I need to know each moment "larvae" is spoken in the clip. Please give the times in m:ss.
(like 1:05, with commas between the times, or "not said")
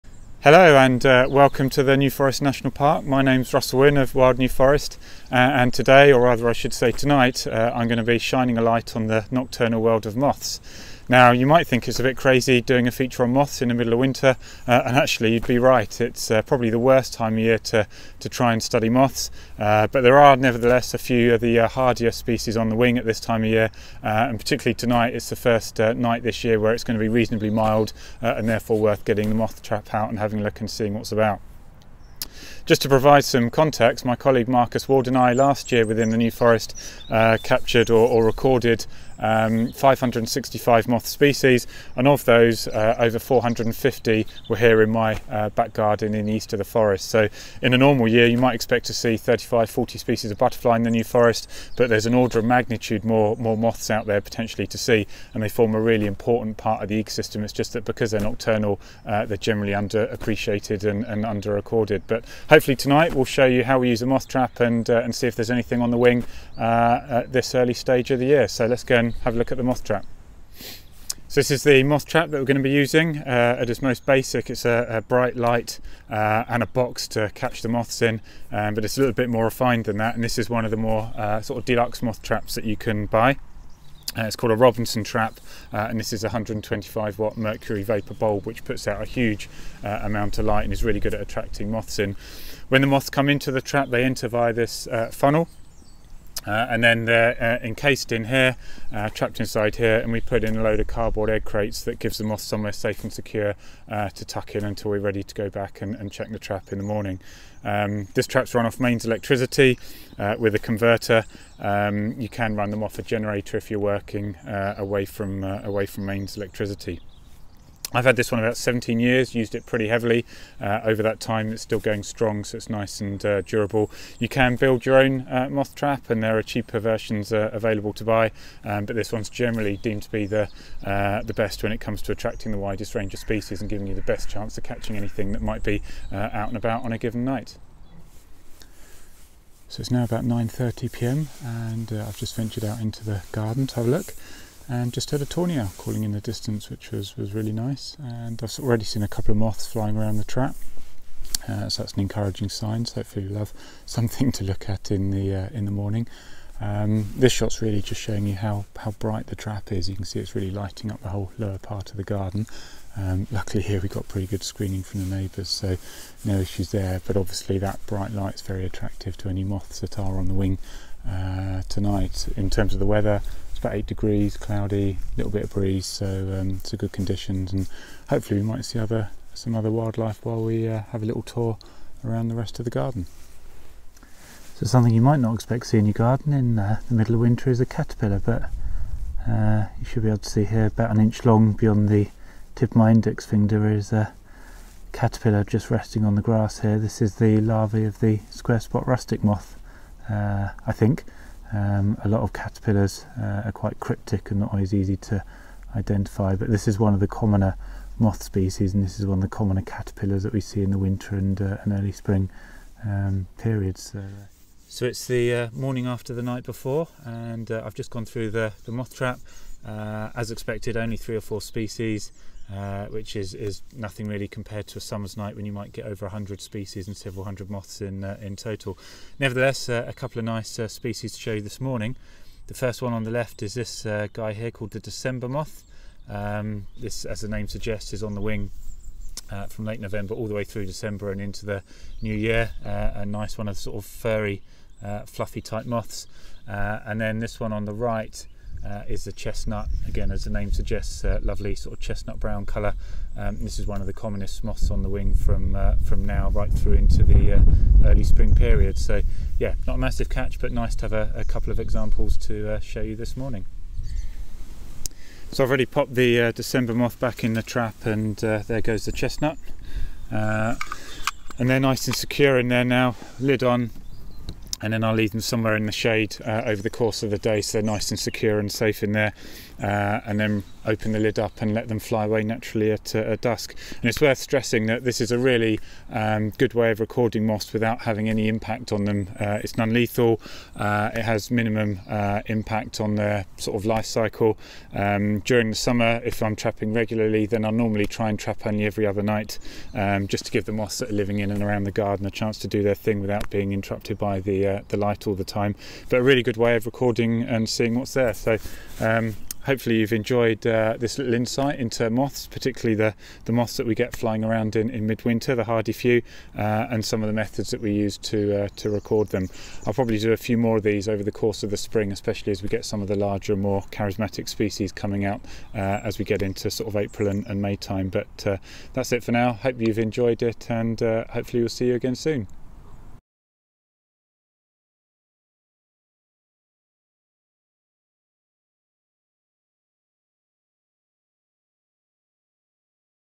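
3:17.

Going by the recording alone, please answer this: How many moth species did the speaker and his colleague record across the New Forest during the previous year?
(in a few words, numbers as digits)
565.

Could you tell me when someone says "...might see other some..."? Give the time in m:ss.
2:58.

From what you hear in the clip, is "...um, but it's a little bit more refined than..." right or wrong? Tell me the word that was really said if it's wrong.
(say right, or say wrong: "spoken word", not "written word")
right.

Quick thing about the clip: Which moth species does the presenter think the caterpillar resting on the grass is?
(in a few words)
Square spot rustic.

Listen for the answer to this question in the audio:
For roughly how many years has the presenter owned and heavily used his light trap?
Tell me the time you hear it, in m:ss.
1:58.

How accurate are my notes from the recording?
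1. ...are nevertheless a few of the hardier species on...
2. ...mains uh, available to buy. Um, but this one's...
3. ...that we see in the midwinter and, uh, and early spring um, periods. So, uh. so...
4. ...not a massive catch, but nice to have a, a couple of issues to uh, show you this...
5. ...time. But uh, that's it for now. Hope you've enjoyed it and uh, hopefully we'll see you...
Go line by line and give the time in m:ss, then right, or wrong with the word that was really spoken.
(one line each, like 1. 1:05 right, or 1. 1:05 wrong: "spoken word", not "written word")
1. 0:20 right
2. 2:06 wrong: "versions", not "mains"
3. 3:30 wrong: "winter", not "midwinter"
4. 4:19 wrong: "examples", not "issues"
5. 5:27 right.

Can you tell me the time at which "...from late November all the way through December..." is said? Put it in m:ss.
3:59.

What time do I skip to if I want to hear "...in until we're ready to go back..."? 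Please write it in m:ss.
1:44.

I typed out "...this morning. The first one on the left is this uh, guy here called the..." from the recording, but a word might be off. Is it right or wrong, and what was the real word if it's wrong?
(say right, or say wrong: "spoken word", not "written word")
right.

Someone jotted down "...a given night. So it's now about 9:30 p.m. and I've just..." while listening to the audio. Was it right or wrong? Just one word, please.
right.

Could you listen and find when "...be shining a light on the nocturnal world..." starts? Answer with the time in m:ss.
0:08.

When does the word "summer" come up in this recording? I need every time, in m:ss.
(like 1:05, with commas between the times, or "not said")
3:44, 4:55.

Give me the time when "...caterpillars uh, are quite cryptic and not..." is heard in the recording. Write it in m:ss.
3:22.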